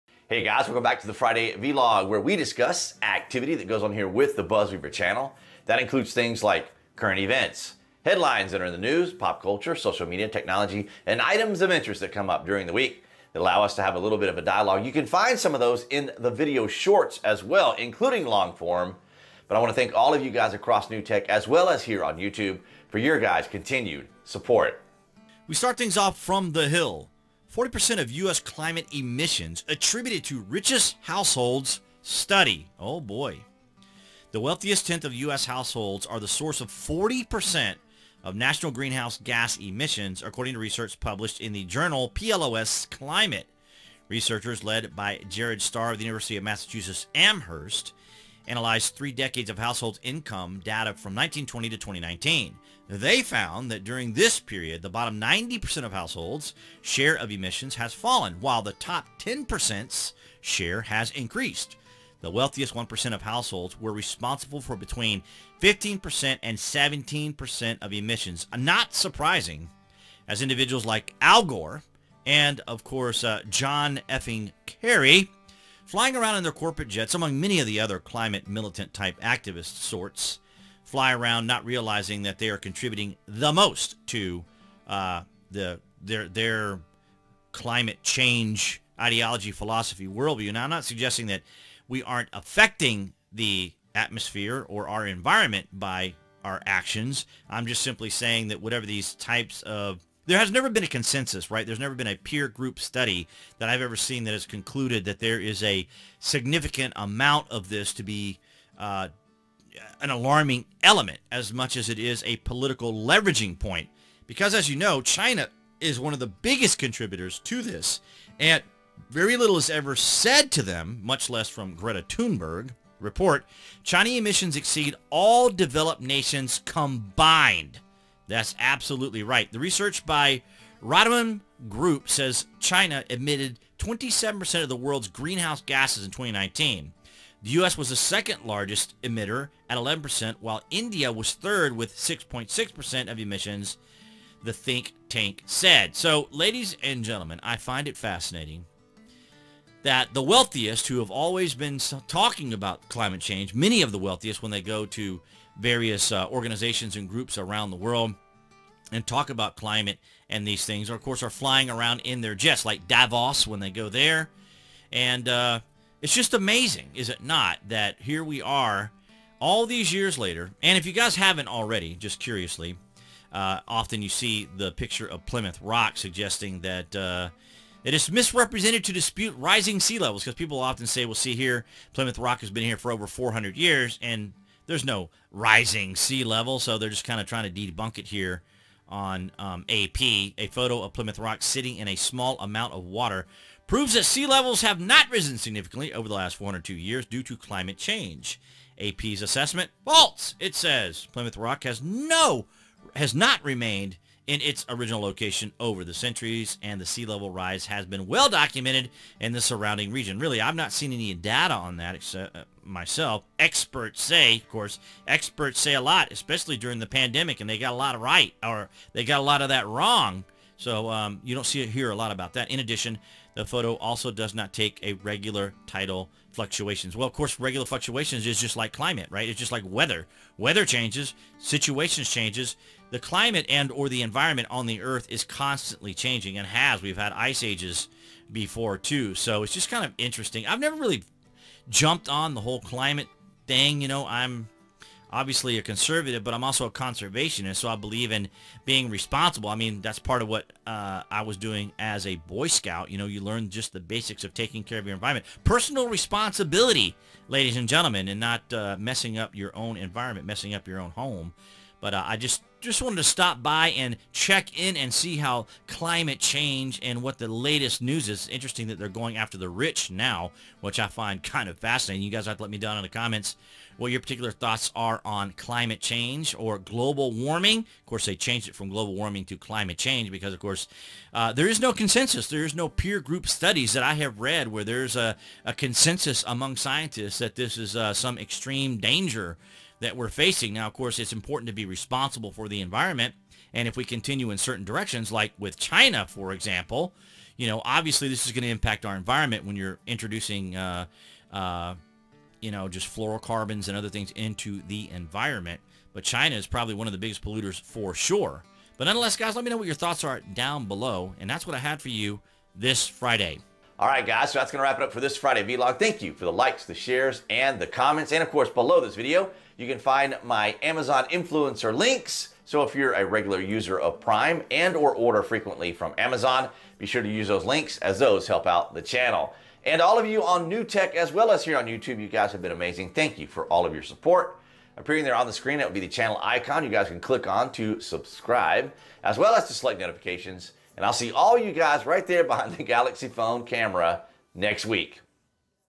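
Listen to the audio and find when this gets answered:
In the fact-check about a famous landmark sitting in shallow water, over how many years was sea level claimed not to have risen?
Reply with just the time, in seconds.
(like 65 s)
196 s.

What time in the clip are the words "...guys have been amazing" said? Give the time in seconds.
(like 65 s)
332 s.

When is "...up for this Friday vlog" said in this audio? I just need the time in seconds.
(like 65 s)
314 s.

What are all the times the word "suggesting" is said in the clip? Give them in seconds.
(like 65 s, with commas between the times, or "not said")
90 s, 175 s.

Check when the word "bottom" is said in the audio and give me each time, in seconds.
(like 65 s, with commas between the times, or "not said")
54 s.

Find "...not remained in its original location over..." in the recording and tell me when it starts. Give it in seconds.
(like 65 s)
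203 s.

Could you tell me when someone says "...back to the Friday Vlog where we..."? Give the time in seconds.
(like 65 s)
0 s.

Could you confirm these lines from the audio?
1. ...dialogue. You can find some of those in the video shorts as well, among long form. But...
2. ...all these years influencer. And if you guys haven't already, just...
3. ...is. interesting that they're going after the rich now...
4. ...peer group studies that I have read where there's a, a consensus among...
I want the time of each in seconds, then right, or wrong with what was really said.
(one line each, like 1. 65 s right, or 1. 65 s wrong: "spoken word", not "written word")
1. 14 s wrong: "including", not "among"
2. 169 s wrong: "later", not "influencer"
3. 268 s right
4. 282 s right.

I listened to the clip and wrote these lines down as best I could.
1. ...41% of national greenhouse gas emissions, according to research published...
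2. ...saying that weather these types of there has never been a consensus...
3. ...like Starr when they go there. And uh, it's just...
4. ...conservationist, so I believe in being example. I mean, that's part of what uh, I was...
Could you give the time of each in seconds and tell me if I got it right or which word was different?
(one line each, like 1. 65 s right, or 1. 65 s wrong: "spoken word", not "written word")
1. 36 s wrong: "40", not "41"
2. 98 s wrong: "whatever", not "weather"
3. 162 s wrong: "Davos", not "Starr"
4. 246 s wrong: "responsible", not "example".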